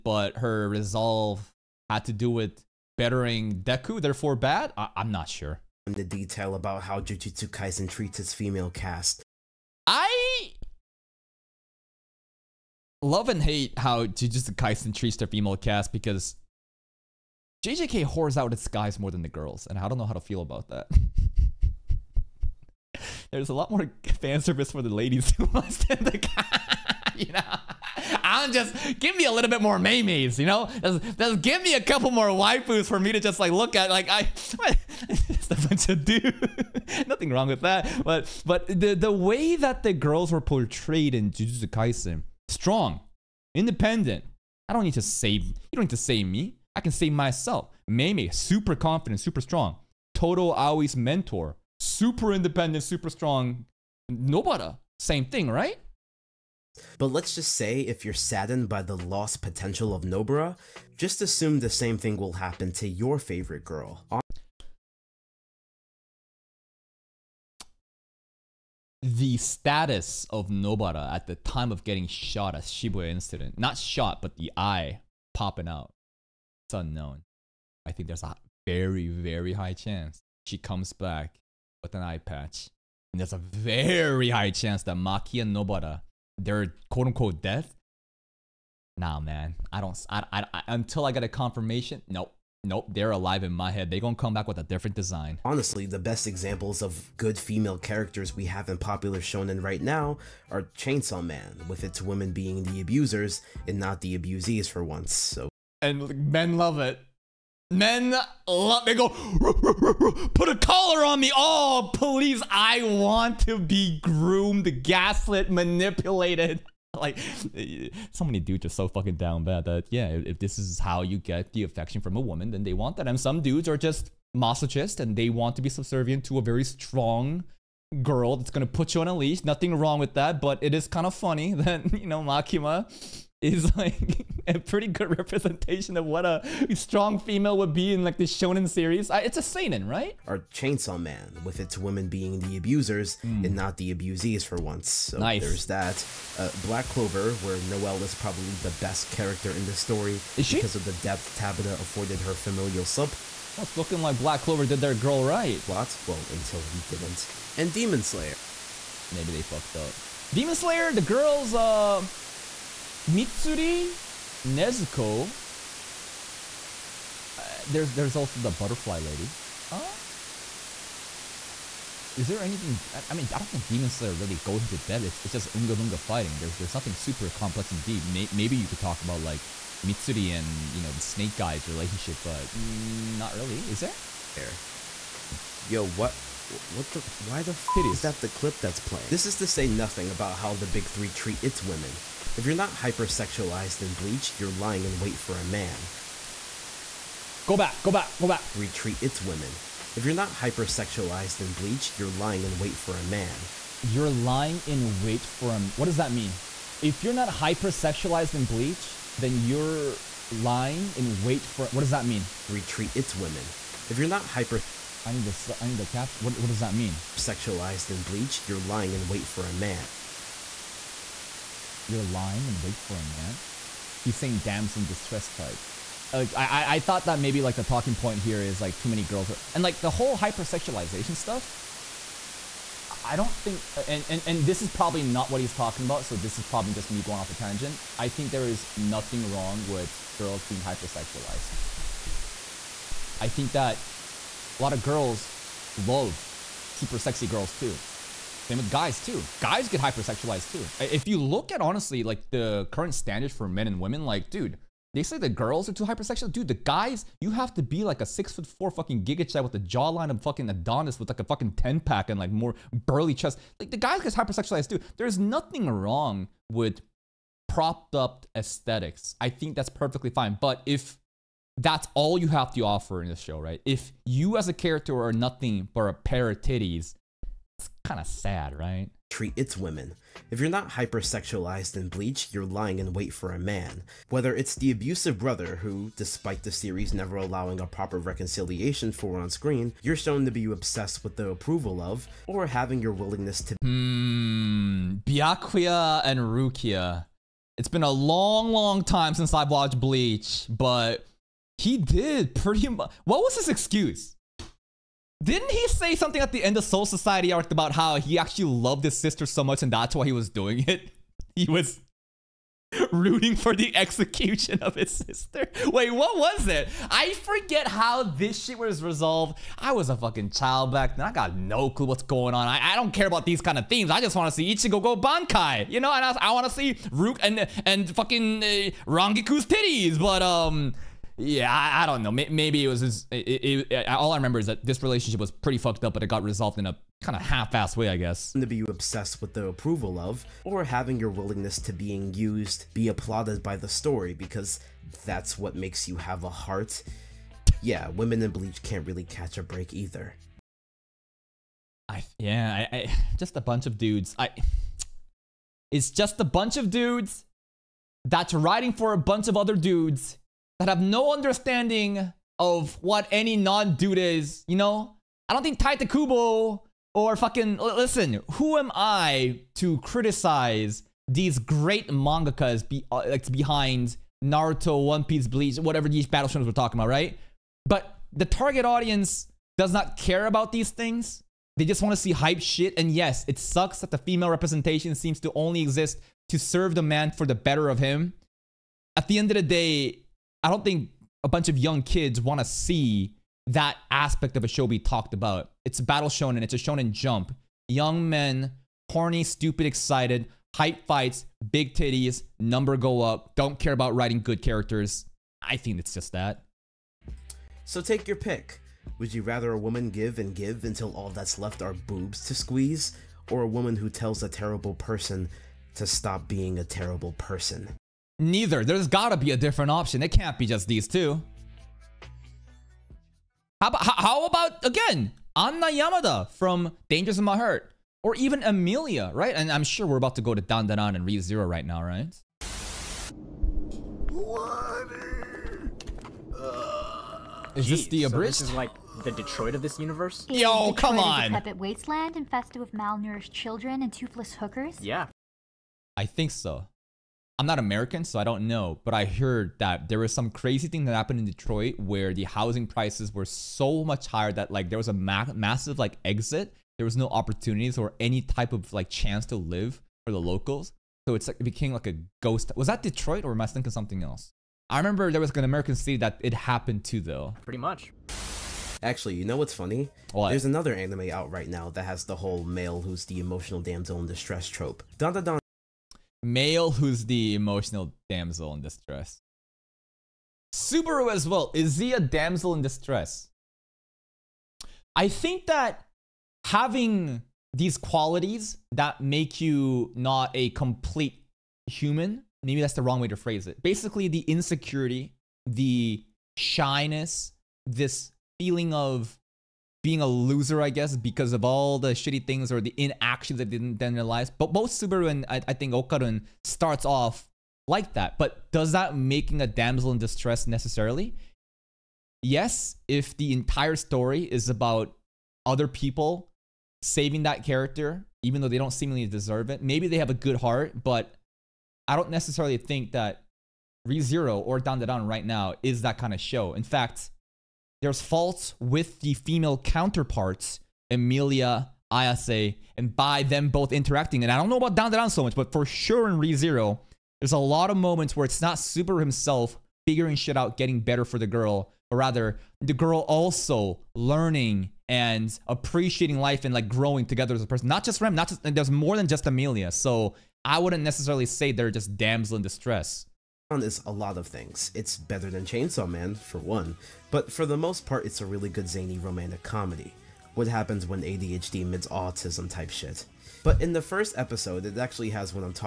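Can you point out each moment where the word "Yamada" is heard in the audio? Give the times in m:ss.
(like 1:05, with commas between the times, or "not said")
7:05.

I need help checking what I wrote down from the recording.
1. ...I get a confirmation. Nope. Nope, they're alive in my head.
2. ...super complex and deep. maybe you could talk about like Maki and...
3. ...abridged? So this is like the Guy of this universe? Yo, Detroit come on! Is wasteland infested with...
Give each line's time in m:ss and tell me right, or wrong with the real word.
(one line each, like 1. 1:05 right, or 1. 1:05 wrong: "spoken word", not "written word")
1. 1:31 right
2. 2:56 wrong: "Mitsuri", not "Maki"
3. 7:18 wrong: "Detroit", not "Guy".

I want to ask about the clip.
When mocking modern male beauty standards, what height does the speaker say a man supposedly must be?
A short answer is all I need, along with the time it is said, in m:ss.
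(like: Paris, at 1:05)
6'4", at 4:18.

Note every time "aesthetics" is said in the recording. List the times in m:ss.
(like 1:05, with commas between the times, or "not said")
4:28.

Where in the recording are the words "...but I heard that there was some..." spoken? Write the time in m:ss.
7:28.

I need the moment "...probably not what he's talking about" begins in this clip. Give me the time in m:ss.
3:54.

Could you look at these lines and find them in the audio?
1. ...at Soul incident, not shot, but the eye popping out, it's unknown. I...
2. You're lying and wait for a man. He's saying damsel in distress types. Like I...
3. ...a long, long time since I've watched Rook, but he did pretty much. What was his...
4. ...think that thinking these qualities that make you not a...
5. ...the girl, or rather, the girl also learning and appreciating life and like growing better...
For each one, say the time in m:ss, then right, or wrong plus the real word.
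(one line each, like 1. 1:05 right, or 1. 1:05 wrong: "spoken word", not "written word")
1. 1:12 wrong: "Shibuya", not "Soul"
2. 3:41 right
3. 4:57 wrong: "Bleach", not "Rook"
4. 8:05 wrong: "having", not "thinking"
5. 9:01 wrong: "together", not "better".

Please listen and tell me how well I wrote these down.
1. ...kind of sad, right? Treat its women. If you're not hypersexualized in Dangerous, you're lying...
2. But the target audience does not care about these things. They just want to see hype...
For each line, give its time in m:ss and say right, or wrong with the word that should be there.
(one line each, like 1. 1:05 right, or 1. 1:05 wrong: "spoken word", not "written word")
1. 4:37 wrong: "Bleach", not "Dangerous"
2. 6:17 right.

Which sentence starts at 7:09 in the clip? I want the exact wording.
And I'm sure we're about to go to Dandadan and ReZero right now, right?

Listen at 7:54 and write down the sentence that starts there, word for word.
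Dun dun dun male who's the emotional damsel in distress.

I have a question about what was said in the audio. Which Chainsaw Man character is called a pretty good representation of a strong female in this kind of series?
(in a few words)
Makima.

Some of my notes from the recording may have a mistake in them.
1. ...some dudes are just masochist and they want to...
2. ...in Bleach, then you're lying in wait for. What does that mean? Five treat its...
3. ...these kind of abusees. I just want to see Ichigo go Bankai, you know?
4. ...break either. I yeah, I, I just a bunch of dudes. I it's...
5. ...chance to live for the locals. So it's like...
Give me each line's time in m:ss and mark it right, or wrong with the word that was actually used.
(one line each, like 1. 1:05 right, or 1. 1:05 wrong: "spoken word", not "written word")
1. 2:03 right
2. 3:28 wrong: "Three", not "Five"
3. 5:23 wrong: "themes", not "abusees"
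4. 5:49 right
5. 7:38 right.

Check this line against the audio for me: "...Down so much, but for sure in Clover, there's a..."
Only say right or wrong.
wrong.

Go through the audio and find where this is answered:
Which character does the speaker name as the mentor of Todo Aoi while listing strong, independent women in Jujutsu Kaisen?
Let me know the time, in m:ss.
0:47.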